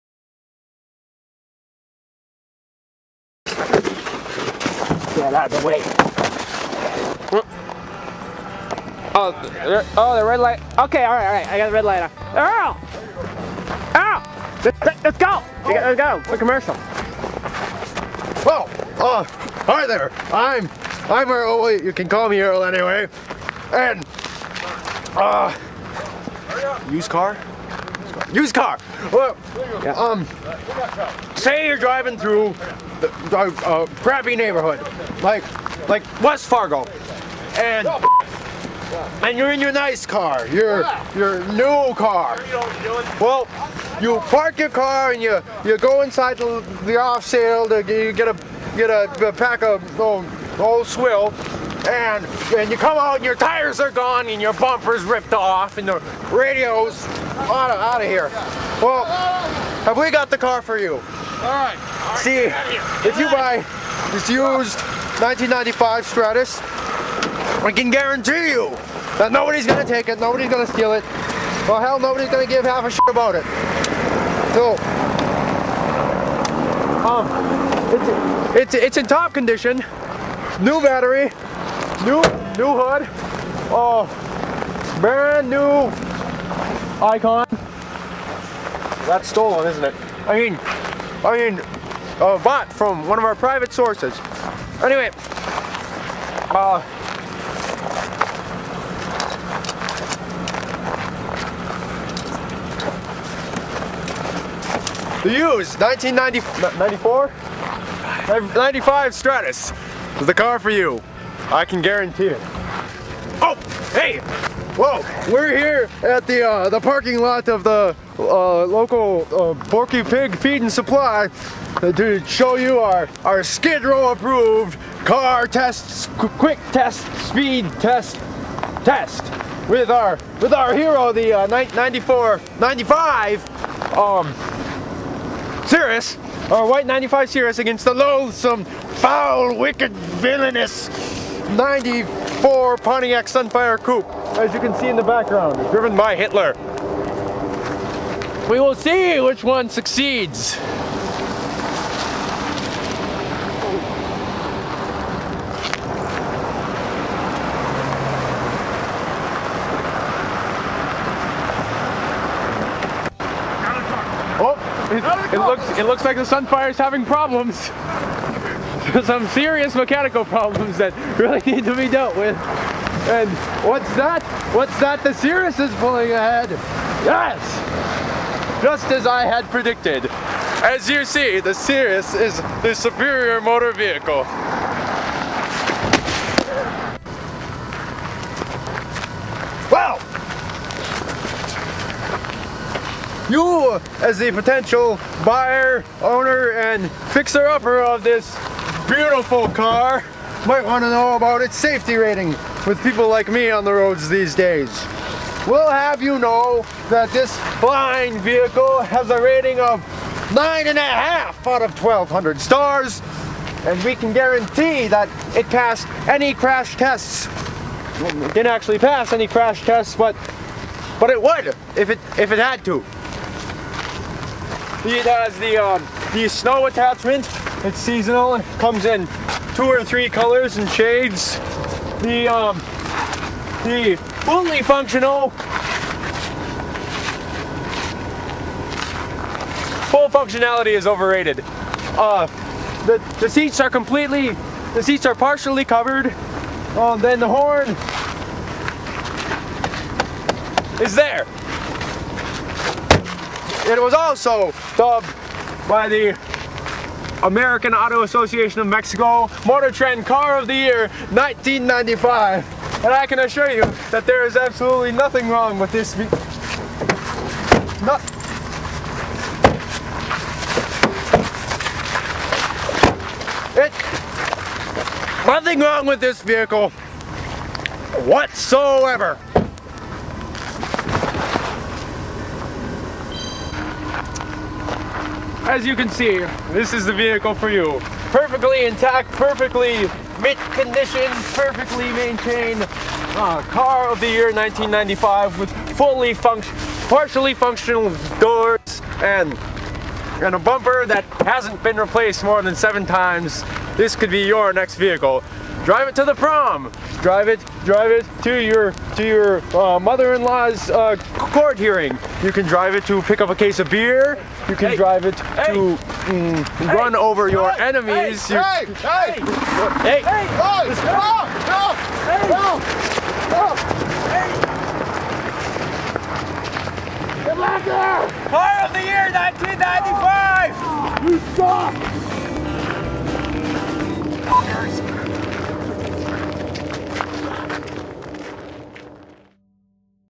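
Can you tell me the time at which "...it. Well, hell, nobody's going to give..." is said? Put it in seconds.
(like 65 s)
70 s.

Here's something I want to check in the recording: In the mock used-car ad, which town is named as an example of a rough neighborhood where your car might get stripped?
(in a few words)
West Fargo.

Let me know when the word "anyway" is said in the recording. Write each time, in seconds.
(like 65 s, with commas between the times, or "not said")
22 s, 94 s.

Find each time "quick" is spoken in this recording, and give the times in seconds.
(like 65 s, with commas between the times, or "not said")
16 s, 126 s.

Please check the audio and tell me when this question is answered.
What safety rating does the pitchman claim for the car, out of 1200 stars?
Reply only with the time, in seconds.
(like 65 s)
210 s.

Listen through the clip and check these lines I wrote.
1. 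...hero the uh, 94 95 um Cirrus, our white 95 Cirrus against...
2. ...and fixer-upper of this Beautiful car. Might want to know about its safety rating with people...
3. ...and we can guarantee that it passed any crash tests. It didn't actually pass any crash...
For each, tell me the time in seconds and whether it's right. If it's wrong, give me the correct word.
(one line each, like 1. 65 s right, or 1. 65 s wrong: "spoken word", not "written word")
1. 130 s right
2. 196 s right
3. 213 s right.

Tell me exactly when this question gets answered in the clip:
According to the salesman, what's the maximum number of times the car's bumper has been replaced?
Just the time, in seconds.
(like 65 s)
302 s.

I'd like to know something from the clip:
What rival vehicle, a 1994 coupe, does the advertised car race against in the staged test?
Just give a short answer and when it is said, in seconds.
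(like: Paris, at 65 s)
Pontiac Sunfire Coupe, at 142 s.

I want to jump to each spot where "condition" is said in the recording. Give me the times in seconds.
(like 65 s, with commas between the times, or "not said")
79 s, 290 s.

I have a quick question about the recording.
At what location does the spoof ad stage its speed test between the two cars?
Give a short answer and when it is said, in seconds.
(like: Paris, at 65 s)
Porky Pig Feed and Supply, at 119 s.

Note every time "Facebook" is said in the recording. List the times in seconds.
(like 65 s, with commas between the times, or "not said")
not said.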